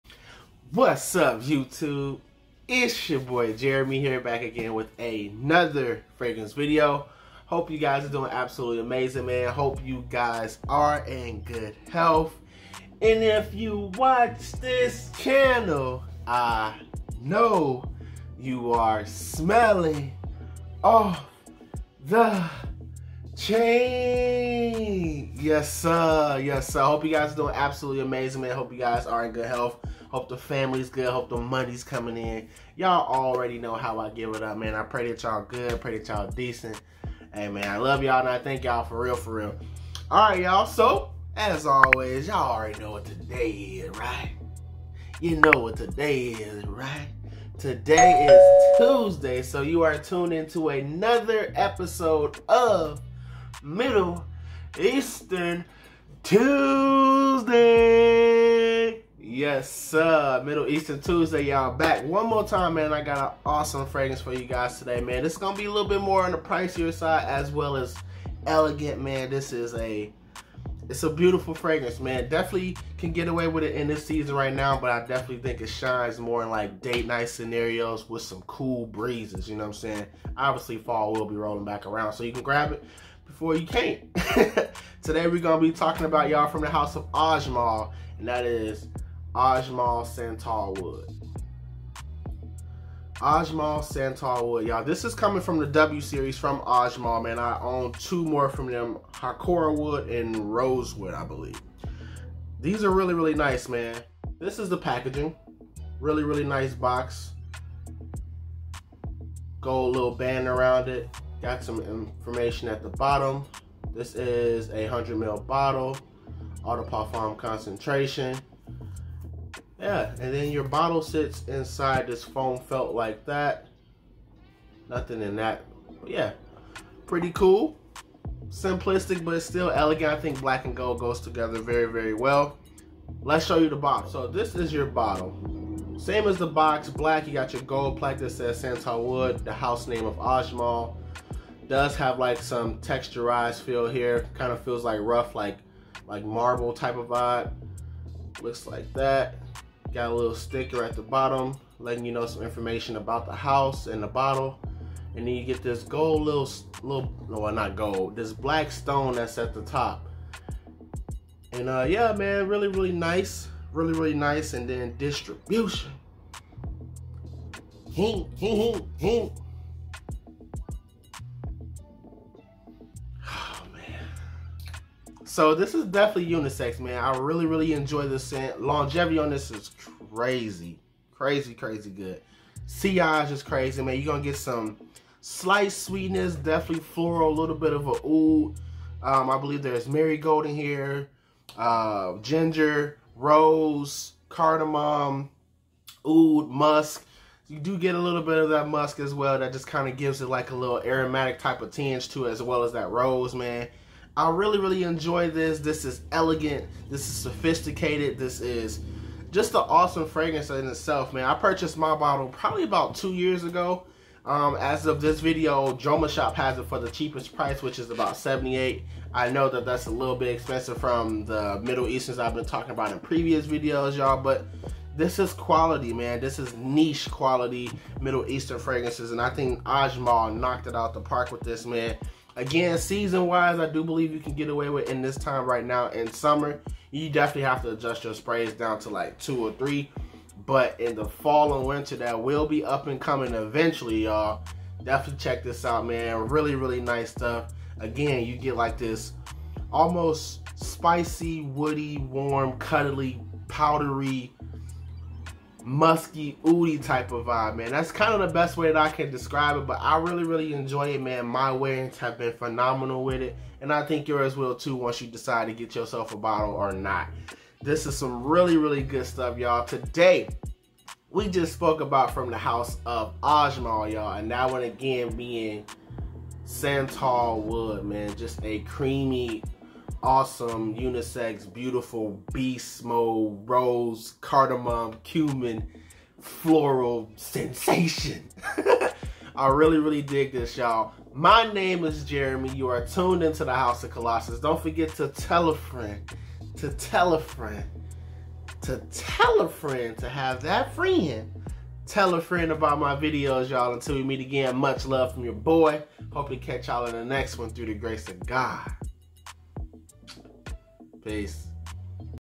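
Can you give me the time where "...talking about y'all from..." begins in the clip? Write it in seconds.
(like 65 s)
85 s.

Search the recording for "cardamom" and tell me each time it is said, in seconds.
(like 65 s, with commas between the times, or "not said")
194 s, 284 s.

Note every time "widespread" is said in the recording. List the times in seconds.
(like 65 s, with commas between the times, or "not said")
not said.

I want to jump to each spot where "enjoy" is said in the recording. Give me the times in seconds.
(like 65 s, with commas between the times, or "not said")
177 s, 204 s, 260 s.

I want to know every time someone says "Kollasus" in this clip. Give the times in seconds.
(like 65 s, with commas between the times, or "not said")
293 s.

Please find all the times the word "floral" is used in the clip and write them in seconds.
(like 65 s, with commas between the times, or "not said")
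186 s, 286 s.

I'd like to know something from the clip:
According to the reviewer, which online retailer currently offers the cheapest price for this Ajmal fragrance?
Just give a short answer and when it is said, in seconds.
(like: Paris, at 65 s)
Jomashop, at 215 s.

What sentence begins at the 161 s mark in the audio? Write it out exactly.
And uh, yeah, man, really, really nice.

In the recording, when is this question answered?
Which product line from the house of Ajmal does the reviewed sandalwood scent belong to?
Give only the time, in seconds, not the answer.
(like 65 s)
95 s.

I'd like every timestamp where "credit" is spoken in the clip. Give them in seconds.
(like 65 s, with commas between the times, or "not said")
not said.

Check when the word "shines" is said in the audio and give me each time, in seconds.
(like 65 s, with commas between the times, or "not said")
75 s.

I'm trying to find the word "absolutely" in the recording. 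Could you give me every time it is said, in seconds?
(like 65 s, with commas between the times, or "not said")
8 s, 27 s.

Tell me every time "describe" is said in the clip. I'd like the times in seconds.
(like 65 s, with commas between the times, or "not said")
259 s.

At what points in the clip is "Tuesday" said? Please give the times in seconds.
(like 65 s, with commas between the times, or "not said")
48 s, 56 s, 61 s.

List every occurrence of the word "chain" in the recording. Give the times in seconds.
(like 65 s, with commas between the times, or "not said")
23 s.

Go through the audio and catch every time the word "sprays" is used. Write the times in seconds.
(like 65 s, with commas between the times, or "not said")
238 s.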